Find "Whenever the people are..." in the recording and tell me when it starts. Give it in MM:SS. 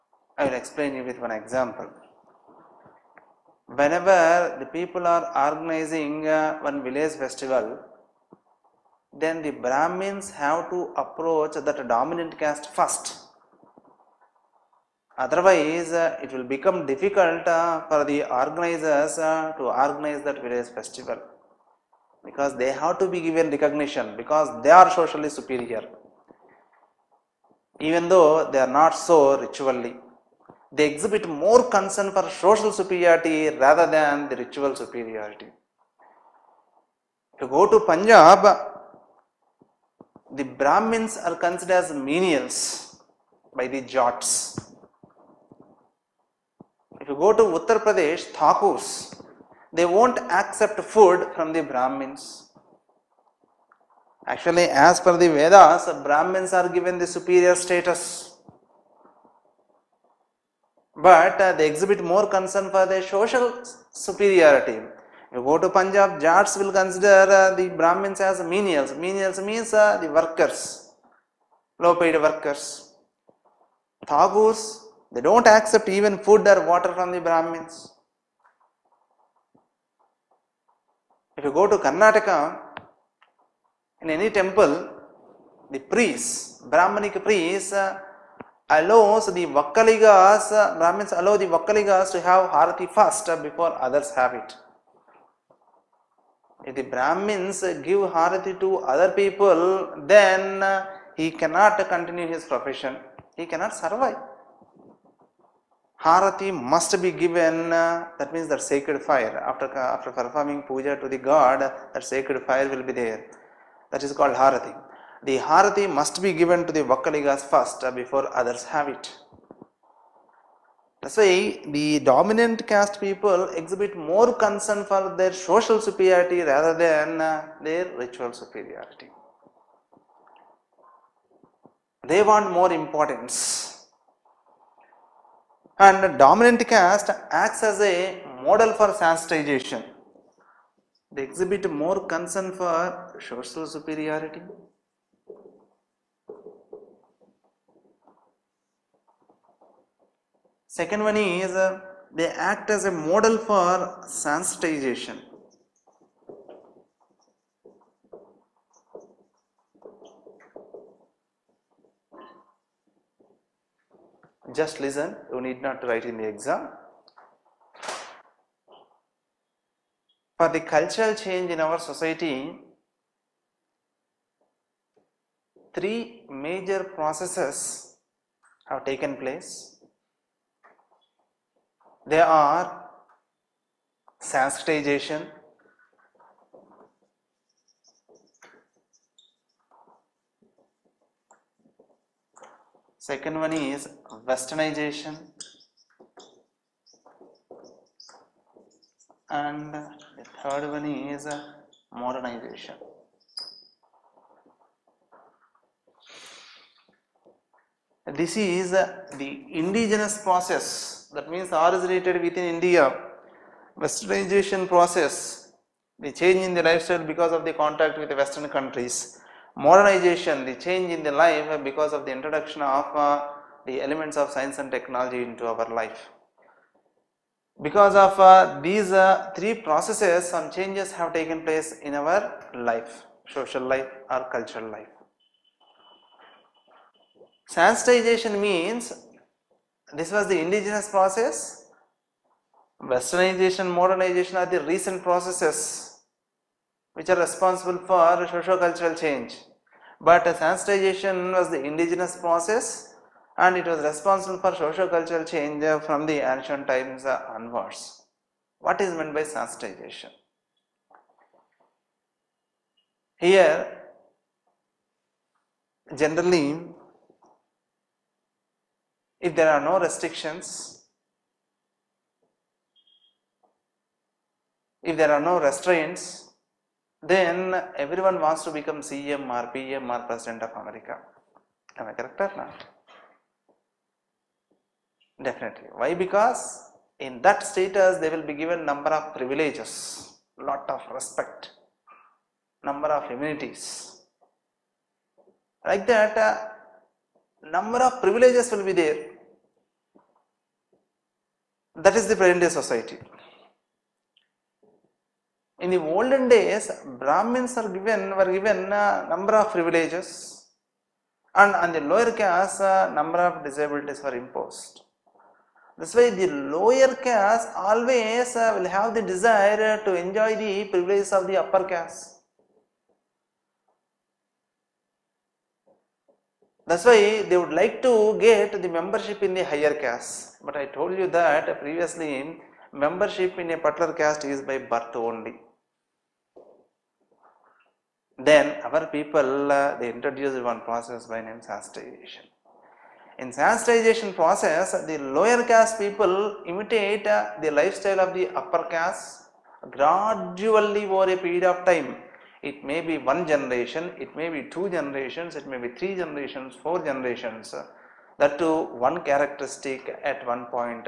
00:03.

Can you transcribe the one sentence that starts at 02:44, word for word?
Just listen, you need not write in the exam.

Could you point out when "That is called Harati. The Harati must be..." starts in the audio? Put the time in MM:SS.
01:53.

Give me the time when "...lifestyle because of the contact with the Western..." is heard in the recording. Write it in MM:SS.
03:36.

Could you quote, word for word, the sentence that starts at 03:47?
Because of uh, these uh, three processes, some changes have taken place in our life, social life or cultural life.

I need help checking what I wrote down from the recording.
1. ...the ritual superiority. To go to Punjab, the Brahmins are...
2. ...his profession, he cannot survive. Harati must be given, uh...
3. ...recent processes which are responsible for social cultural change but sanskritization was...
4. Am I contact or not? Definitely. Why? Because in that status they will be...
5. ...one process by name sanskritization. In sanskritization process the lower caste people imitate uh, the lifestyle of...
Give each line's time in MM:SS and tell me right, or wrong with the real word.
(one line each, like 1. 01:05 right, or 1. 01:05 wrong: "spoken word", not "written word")
1. 00:34 right
2. 01:42 right
3. 04:04 right
4. 04:41 wrong: "correct", not "contact"
5. 05:40 right.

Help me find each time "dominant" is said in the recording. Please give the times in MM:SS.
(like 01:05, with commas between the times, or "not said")
00:11, 02:01, 02:16.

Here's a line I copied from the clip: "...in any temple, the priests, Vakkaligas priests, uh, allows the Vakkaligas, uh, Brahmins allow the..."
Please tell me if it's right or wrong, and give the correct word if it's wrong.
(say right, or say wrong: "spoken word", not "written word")
wrong: "Brahmanic", not "Vakkaligas".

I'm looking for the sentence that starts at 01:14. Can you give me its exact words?
Thakurs, they don't accept even food or water from the Brahmins.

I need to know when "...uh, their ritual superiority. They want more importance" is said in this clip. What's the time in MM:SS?
02:07.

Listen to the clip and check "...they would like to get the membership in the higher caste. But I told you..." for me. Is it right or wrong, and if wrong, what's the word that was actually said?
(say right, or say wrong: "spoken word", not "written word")
right.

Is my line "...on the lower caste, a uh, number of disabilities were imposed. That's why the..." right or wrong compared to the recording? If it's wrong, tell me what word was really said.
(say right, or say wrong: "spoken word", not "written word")
right.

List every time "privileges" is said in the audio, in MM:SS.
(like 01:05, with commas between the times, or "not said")
04:49, 04:58, 05:09, 05:20.